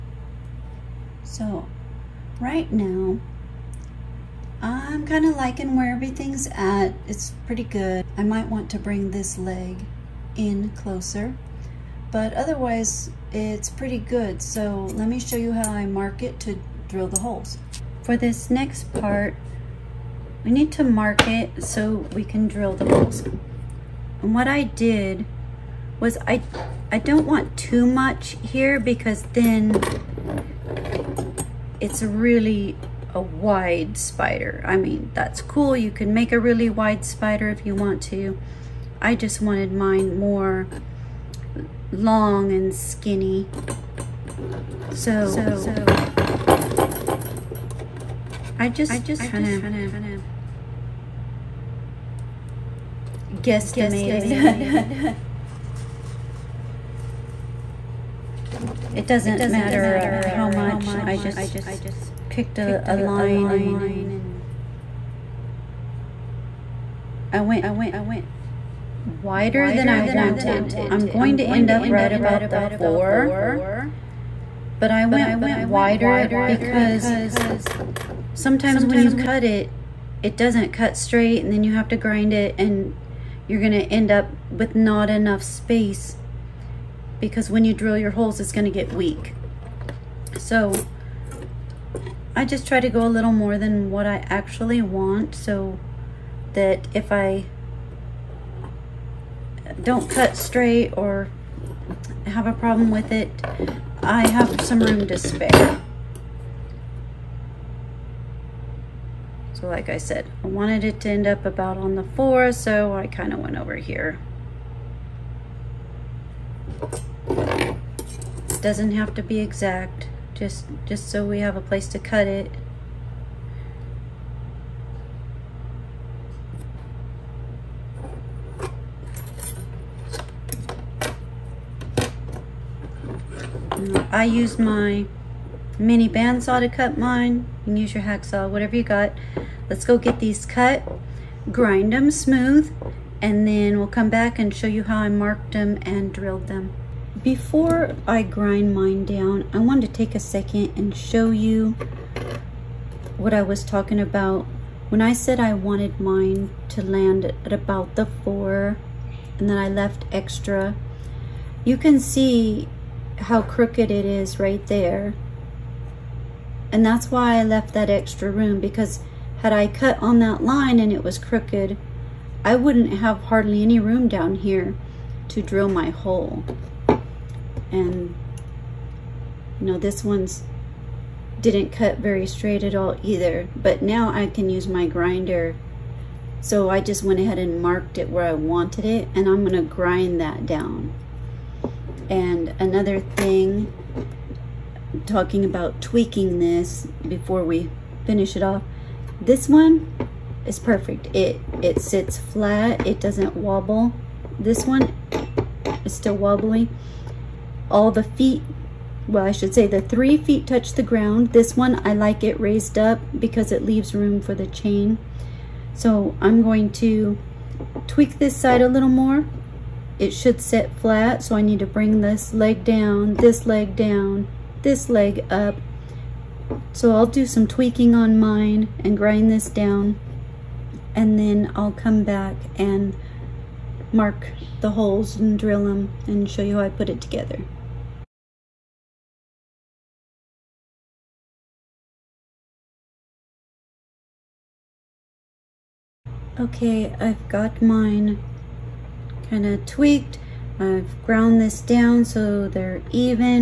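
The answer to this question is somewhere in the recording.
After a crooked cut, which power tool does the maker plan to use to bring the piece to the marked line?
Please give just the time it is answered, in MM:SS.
03:04.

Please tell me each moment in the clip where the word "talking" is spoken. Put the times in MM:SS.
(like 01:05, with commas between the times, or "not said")
02:33, 03:15.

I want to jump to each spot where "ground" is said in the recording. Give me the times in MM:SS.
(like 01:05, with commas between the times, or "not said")
03:30, 04:11.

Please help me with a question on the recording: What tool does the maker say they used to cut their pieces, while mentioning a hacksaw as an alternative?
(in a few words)
mini bandsaw.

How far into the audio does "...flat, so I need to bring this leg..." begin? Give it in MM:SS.
03:40.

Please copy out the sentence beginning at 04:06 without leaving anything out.
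Okay, I've got mine kind of tweaked.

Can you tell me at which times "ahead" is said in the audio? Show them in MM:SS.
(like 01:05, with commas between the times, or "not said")
03:07.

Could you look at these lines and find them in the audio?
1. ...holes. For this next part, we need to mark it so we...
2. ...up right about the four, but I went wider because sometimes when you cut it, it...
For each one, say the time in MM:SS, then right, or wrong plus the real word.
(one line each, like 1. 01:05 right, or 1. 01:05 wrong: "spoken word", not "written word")
1. 00:17 right
2. 01:11 right.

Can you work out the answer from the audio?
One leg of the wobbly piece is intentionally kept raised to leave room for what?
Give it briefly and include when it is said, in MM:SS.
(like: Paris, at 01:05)
the chain, at 03:34.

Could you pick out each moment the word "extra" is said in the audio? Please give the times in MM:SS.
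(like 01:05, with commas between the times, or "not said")
02:40, 02:47.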